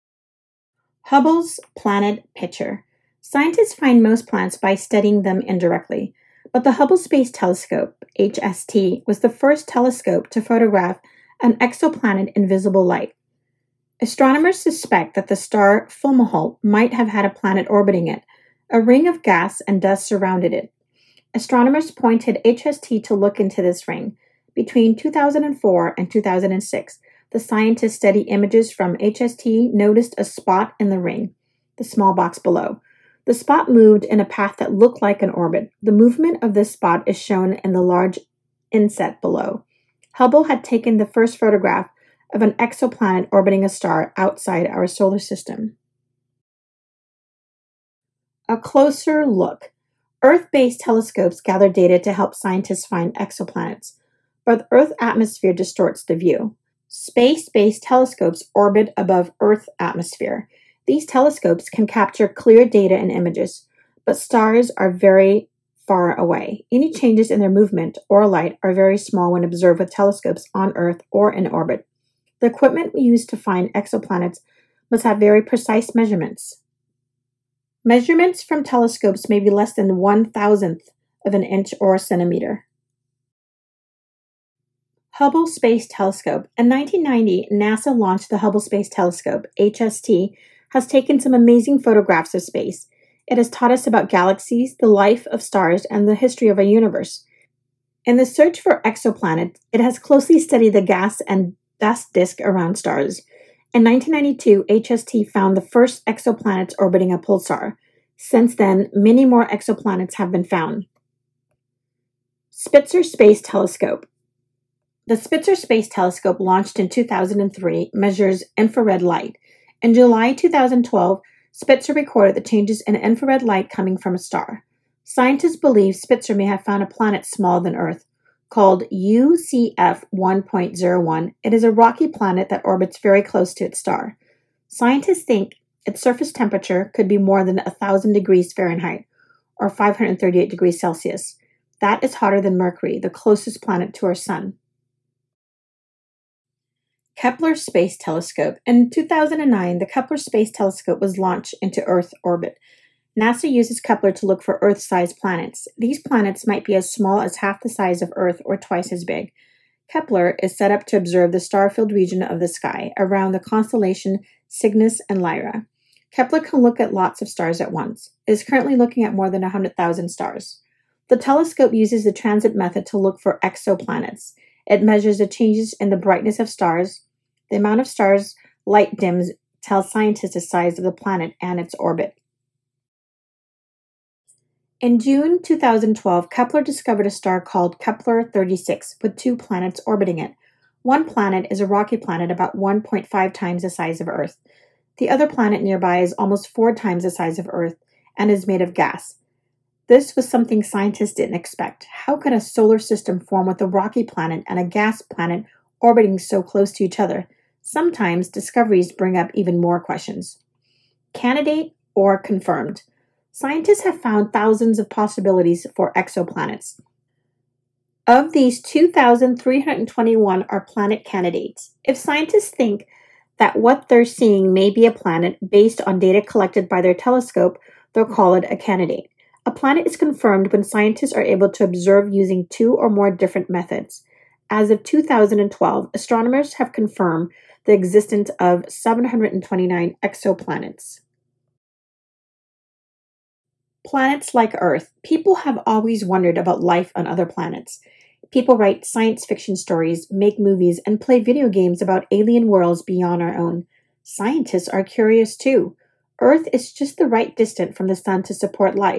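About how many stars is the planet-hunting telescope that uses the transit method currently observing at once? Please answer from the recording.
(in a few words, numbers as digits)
more than 100,000.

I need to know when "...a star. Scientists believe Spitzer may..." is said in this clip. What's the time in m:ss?
2:04.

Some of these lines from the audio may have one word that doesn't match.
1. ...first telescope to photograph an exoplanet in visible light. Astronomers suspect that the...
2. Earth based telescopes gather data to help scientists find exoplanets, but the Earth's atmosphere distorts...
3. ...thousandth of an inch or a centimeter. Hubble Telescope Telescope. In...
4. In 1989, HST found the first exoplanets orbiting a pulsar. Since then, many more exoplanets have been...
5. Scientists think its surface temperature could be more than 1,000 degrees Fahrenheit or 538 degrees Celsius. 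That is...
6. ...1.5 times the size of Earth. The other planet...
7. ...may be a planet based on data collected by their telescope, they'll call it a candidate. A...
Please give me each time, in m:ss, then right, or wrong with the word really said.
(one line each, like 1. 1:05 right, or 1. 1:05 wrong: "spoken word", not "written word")
1. 0:09 right
2. 0:50 right
3. 1:20 wrong: "Space", not "Telescope"
4. 1:43 wrong: "1992", not "1989"
5. 2:14 right
6. 3:12 right
7. 3:44 right.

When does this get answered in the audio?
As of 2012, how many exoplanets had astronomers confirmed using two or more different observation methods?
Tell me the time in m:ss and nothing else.
3:58.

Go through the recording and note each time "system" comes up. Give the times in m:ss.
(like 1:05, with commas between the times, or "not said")
0:45, 3:22.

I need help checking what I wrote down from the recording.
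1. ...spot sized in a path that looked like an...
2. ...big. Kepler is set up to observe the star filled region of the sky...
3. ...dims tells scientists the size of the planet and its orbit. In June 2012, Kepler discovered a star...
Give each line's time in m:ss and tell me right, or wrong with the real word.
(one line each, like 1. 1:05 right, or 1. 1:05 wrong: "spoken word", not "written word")
1. 0:33 wrong: "moved", not "sized"
2. 2:39 right
3. 2:58 right.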